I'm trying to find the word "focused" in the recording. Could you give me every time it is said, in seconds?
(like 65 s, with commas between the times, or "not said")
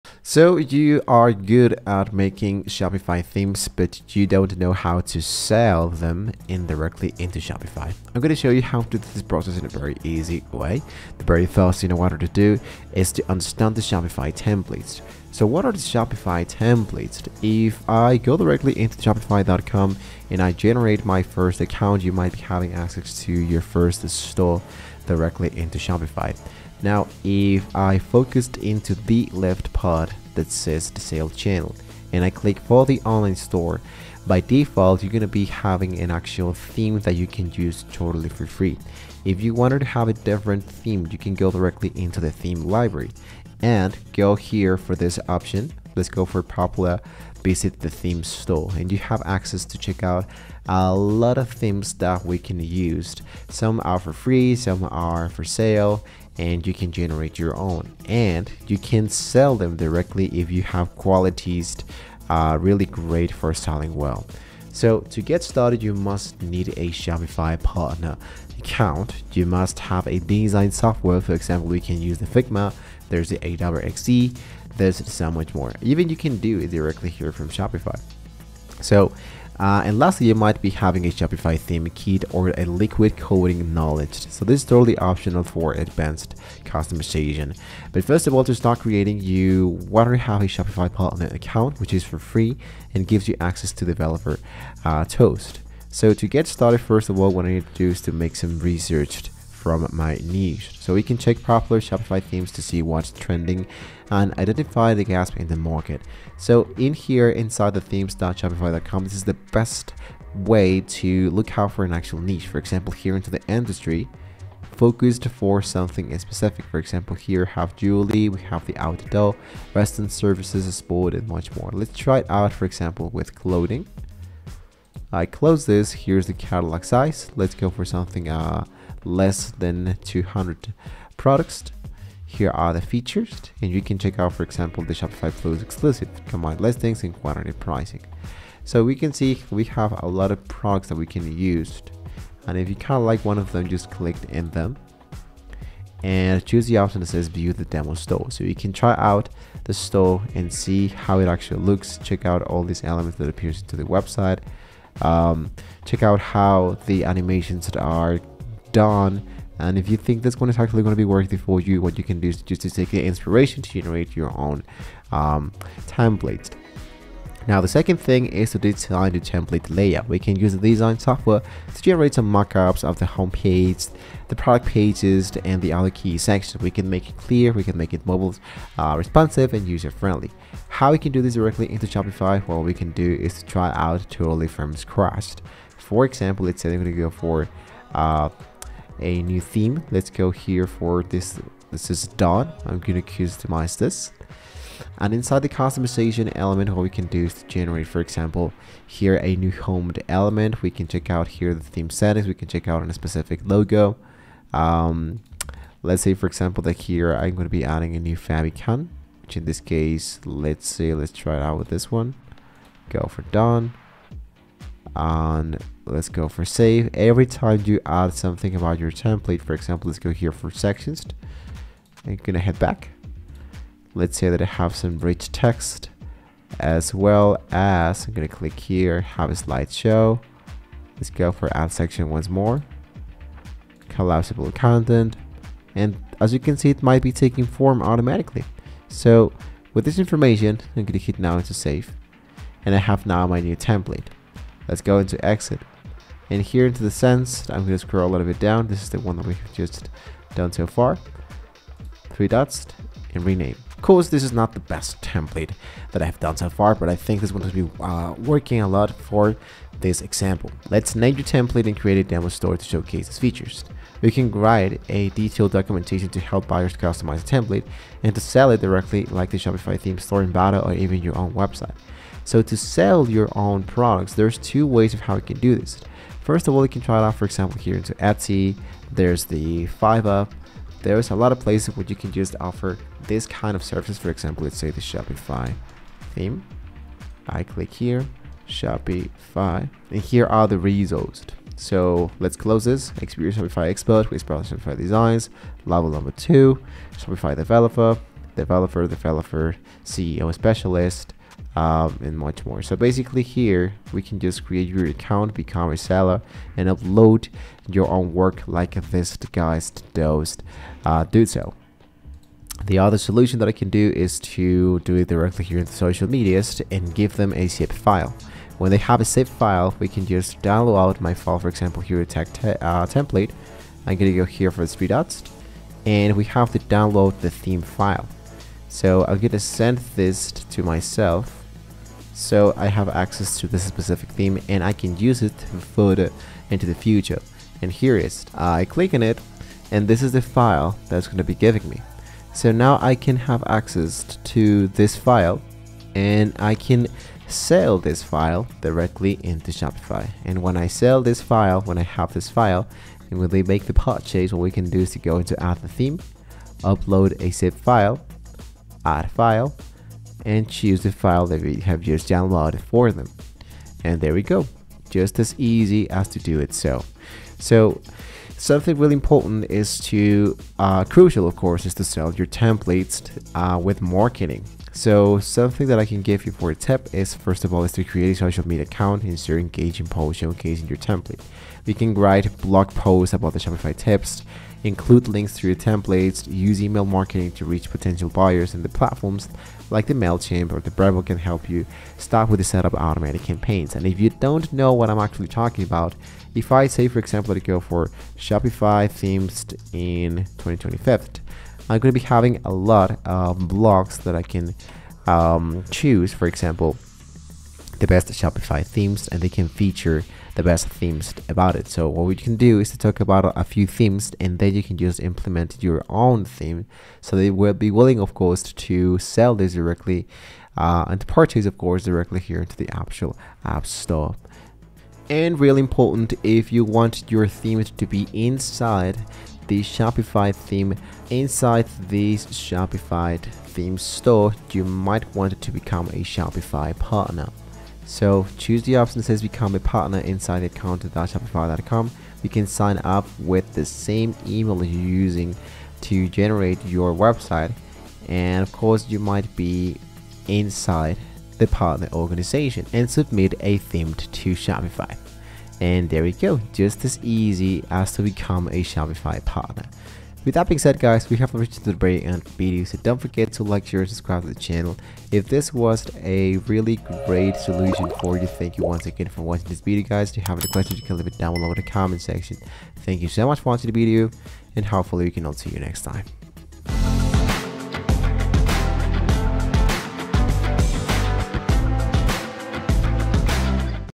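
27 s, 114 s.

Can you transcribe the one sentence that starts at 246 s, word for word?
And here into the sense, I'm going to scroll a little bit down.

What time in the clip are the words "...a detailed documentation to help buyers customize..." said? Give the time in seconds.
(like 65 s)
264 s.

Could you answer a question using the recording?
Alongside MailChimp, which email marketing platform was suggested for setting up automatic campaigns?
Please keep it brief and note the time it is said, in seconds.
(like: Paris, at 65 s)
Brevo, at 390 s.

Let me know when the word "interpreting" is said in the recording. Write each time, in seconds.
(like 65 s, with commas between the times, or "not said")
not said.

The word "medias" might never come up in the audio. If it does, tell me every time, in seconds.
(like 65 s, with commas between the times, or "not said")
316 s, 378 s.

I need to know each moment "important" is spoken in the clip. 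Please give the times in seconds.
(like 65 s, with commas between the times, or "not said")
368 s, 425 s.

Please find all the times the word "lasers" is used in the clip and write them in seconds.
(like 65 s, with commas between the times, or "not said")
not said.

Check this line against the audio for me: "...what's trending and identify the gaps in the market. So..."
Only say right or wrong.
right.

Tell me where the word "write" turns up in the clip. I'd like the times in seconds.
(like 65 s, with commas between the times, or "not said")
264 s, 381 s.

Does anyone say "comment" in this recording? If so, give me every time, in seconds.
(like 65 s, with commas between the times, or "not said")
471 s.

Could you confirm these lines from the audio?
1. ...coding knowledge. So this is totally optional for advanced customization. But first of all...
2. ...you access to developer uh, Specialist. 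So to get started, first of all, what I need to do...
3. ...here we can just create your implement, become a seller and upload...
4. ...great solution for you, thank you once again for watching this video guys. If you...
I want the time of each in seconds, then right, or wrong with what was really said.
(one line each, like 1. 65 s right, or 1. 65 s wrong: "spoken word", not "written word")
1. 83 s right
2. 93 s wrong: "Toast", not "Specialist"
3. 303 s wrong: "account", not "implement"
4. 467 s right.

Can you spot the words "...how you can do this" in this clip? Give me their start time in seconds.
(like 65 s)
275 s.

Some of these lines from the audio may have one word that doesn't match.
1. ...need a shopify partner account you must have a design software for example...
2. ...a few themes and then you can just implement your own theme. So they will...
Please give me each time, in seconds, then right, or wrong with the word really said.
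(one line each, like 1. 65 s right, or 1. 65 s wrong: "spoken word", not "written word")
1. 66 s right
2. 413 s right.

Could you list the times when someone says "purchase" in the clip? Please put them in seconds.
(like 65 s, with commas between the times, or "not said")
353 s, 421 s.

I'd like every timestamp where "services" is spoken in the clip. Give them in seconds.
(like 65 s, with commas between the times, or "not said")
120 s, 283 s.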